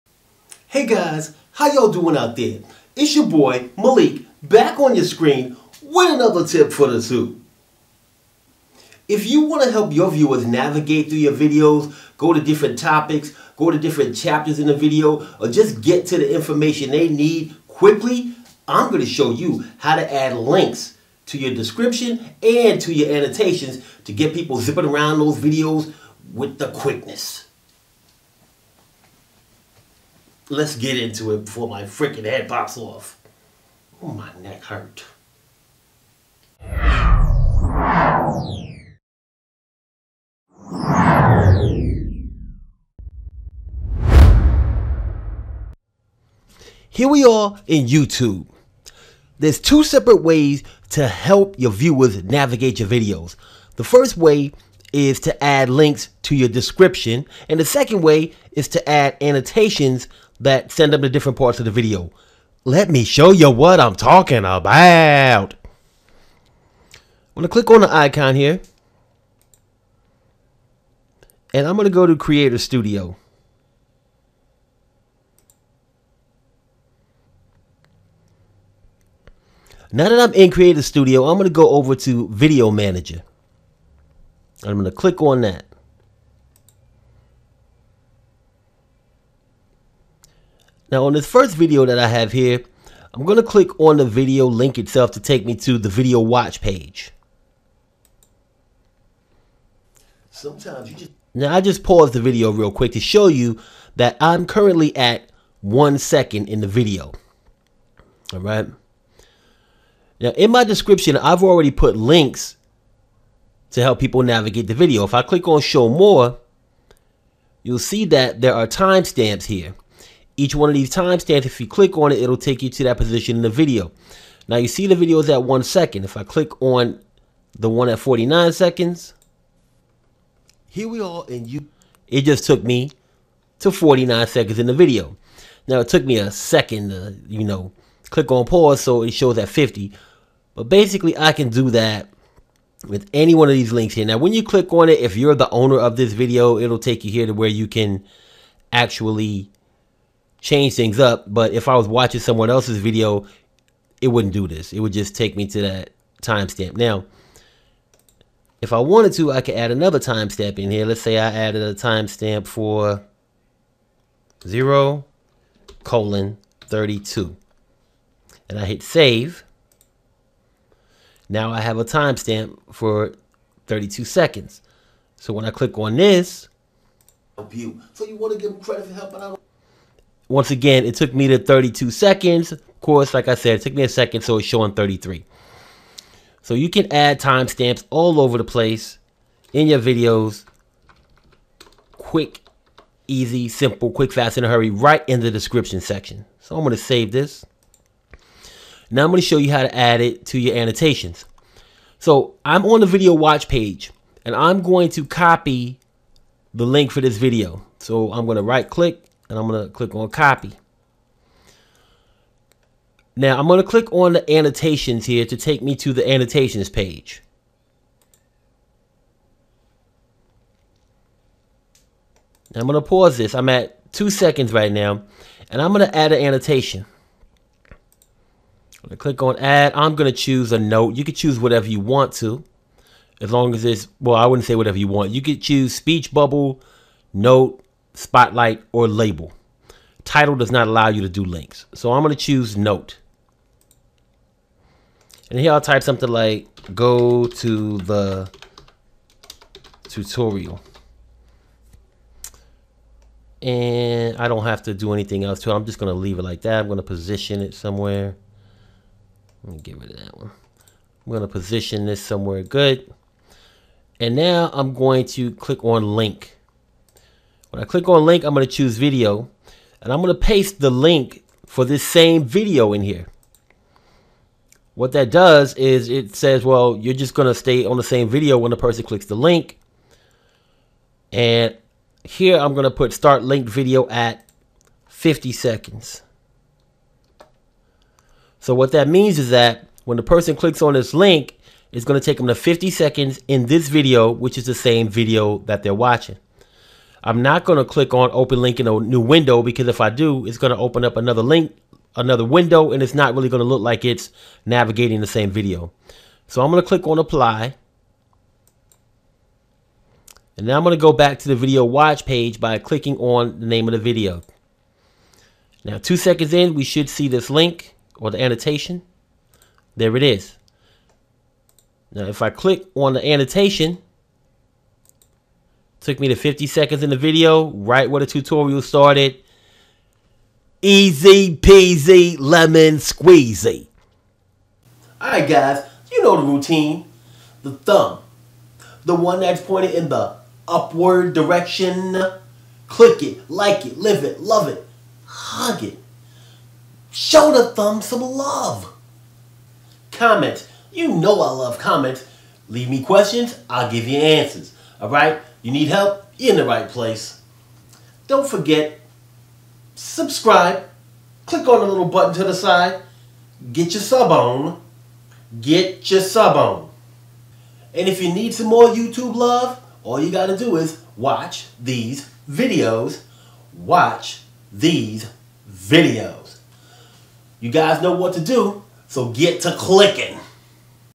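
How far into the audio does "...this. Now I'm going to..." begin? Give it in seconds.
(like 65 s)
197 s.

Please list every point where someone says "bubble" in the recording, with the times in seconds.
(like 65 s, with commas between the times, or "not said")
236 s.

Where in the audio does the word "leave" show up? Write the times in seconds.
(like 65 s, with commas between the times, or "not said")
255 s, 352 s.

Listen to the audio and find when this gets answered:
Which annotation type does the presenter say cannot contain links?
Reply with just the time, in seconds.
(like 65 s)
240 s.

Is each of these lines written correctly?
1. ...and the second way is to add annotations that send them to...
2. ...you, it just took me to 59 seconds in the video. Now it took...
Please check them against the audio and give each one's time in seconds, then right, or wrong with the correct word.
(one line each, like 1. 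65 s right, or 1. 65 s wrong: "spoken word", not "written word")
1. 57 s right
2. 131 s wrong: "49", not "59".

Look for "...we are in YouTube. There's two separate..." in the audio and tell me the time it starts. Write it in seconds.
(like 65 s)
47 s.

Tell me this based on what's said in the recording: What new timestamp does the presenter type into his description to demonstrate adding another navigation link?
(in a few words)
0:32.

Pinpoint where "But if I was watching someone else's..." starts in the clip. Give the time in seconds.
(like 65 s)
151 s.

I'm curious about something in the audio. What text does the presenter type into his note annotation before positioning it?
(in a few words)
go to the tutorial.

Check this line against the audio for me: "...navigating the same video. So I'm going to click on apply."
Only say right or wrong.
right.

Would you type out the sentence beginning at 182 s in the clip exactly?
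Of course, like I said, it took me a second, so it's showing 33.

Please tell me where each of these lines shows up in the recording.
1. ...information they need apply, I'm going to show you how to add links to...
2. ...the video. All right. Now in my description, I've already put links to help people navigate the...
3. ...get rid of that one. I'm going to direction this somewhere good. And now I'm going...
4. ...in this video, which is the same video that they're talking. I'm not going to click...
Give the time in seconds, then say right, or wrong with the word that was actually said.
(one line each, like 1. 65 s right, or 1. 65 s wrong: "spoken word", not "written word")
1. 16 s wrong: "quickly", not "apply"
2. 106 s right
3. 259 s wrong: "position", not "direction"
4. 293 s wrong: "watching", not "talking".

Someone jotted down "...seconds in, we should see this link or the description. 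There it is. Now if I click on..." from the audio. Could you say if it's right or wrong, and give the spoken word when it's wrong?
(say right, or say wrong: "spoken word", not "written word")
wrong: "annotation", not "description".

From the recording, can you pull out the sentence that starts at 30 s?
Let's get into it before my freaking head pops off.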